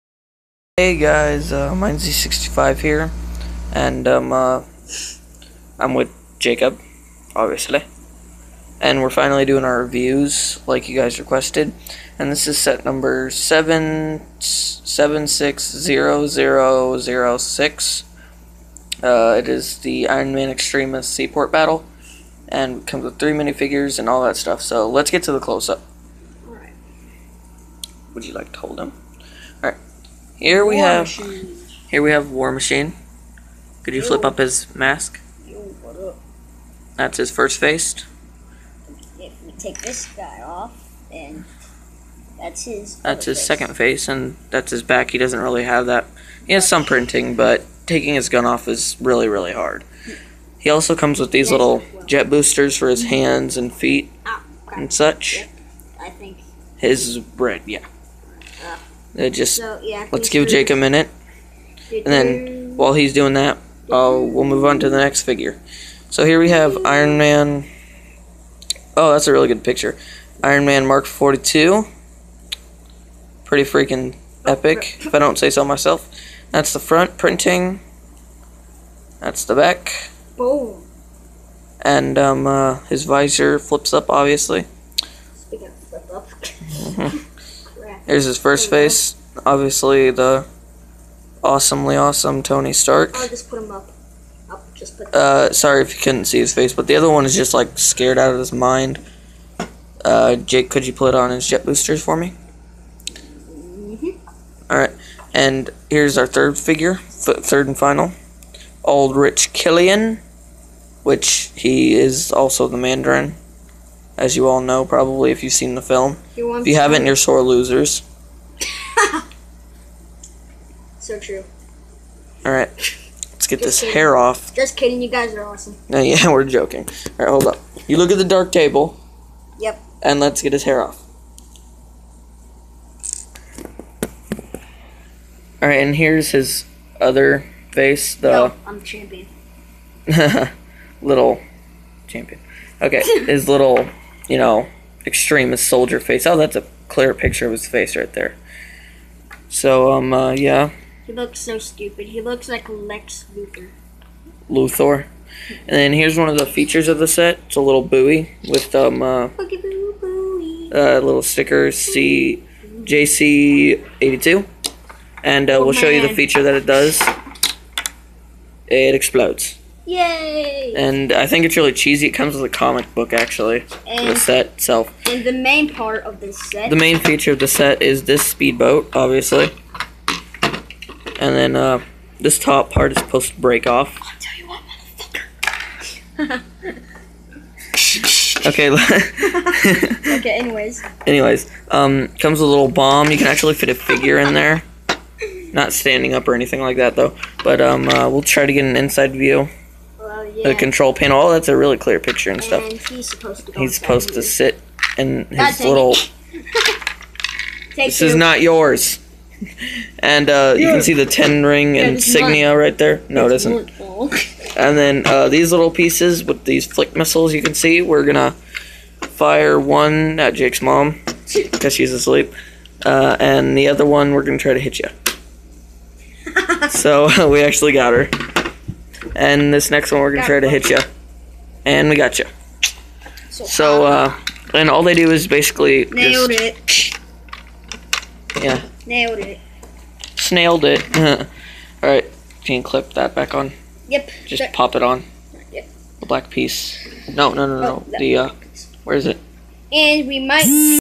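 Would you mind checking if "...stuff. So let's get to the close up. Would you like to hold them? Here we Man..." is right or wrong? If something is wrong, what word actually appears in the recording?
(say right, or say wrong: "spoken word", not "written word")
wrong: "War", not "Man".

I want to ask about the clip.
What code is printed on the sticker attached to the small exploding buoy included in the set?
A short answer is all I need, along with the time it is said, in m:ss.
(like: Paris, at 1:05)
CJC82, at 2:41.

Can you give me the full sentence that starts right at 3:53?
So, uh, and all they do is basically nailed just, it.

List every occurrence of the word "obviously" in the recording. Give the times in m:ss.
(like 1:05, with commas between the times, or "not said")
0:07, 1:24, 1:29, 2:58.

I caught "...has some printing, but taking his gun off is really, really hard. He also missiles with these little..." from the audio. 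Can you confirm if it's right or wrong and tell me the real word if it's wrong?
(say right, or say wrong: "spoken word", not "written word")
wrong: "comes", not "missiles".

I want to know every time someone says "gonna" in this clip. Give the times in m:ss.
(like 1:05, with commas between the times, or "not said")
3:38, 3:44, 3:50.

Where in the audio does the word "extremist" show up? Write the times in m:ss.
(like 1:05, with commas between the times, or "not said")
0:20, 2:25.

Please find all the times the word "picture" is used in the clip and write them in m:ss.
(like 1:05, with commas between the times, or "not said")
1:09, 2:27, 3:21.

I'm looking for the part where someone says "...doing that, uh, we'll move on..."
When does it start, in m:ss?
1:03.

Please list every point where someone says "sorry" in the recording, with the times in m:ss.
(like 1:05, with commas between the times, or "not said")
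1:35.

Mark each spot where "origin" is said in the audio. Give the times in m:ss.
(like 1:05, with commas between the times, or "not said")
not said.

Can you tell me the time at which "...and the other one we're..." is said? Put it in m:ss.
3:43.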